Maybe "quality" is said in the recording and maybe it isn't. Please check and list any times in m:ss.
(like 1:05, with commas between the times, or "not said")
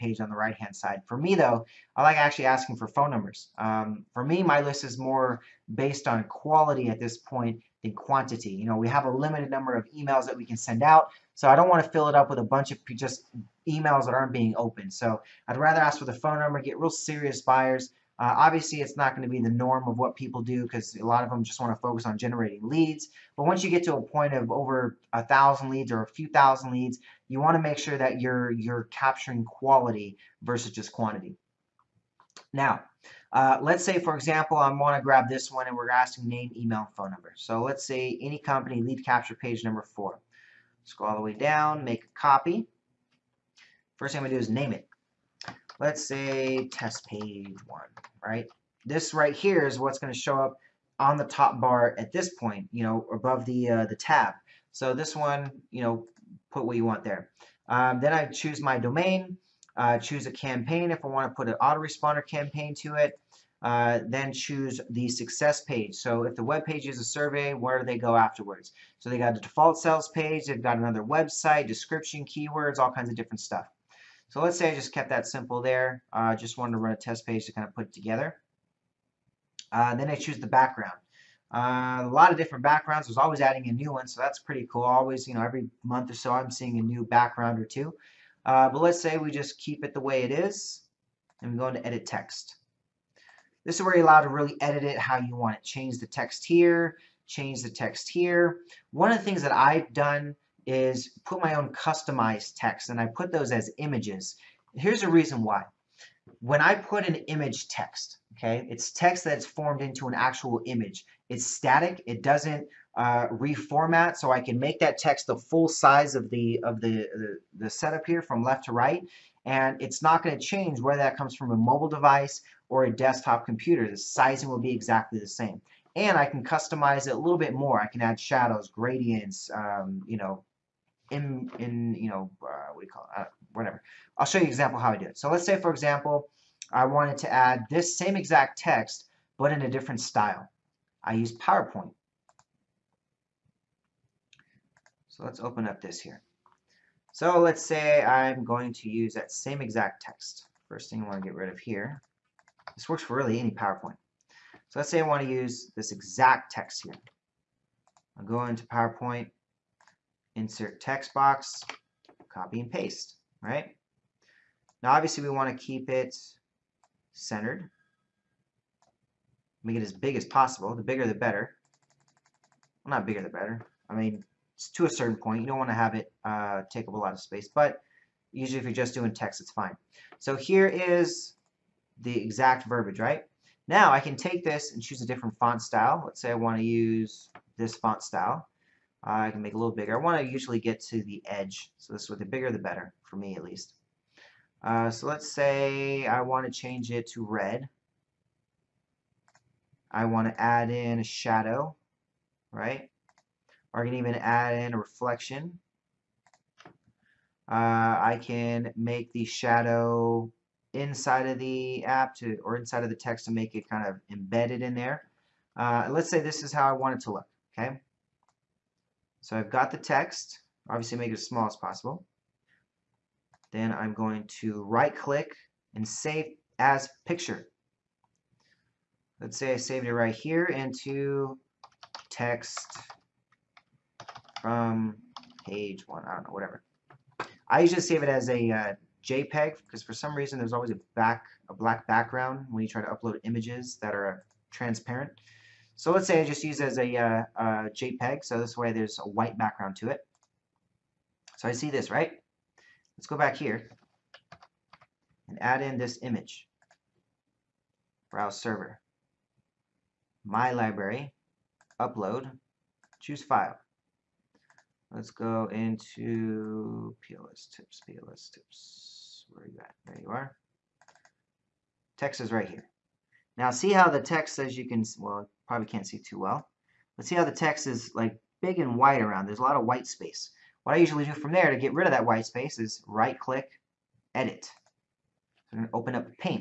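0:06, 0:29.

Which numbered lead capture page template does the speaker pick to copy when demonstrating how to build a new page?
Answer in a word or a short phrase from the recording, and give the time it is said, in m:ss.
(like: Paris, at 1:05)
4, at 0:38.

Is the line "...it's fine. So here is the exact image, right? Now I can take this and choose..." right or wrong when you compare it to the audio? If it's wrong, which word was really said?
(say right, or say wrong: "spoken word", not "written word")
wrong: "verbiage", not "image".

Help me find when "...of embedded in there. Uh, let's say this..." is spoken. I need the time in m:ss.
3:33.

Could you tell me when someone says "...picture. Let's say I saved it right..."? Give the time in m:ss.
3:47.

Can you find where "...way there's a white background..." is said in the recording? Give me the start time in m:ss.
4:08.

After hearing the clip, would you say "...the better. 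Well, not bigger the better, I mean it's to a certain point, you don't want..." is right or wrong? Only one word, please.
right.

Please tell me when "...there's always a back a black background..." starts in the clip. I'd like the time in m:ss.
4:00.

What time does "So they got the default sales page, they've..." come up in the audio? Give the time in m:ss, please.
1:08.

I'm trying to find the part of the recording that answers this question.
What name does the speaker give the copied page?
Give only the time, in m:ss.
0:46.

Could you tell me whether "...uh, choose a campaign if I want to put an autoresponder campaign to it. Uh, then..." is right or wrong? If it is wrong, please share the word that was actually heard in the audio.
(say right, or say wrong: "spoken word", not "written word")
right.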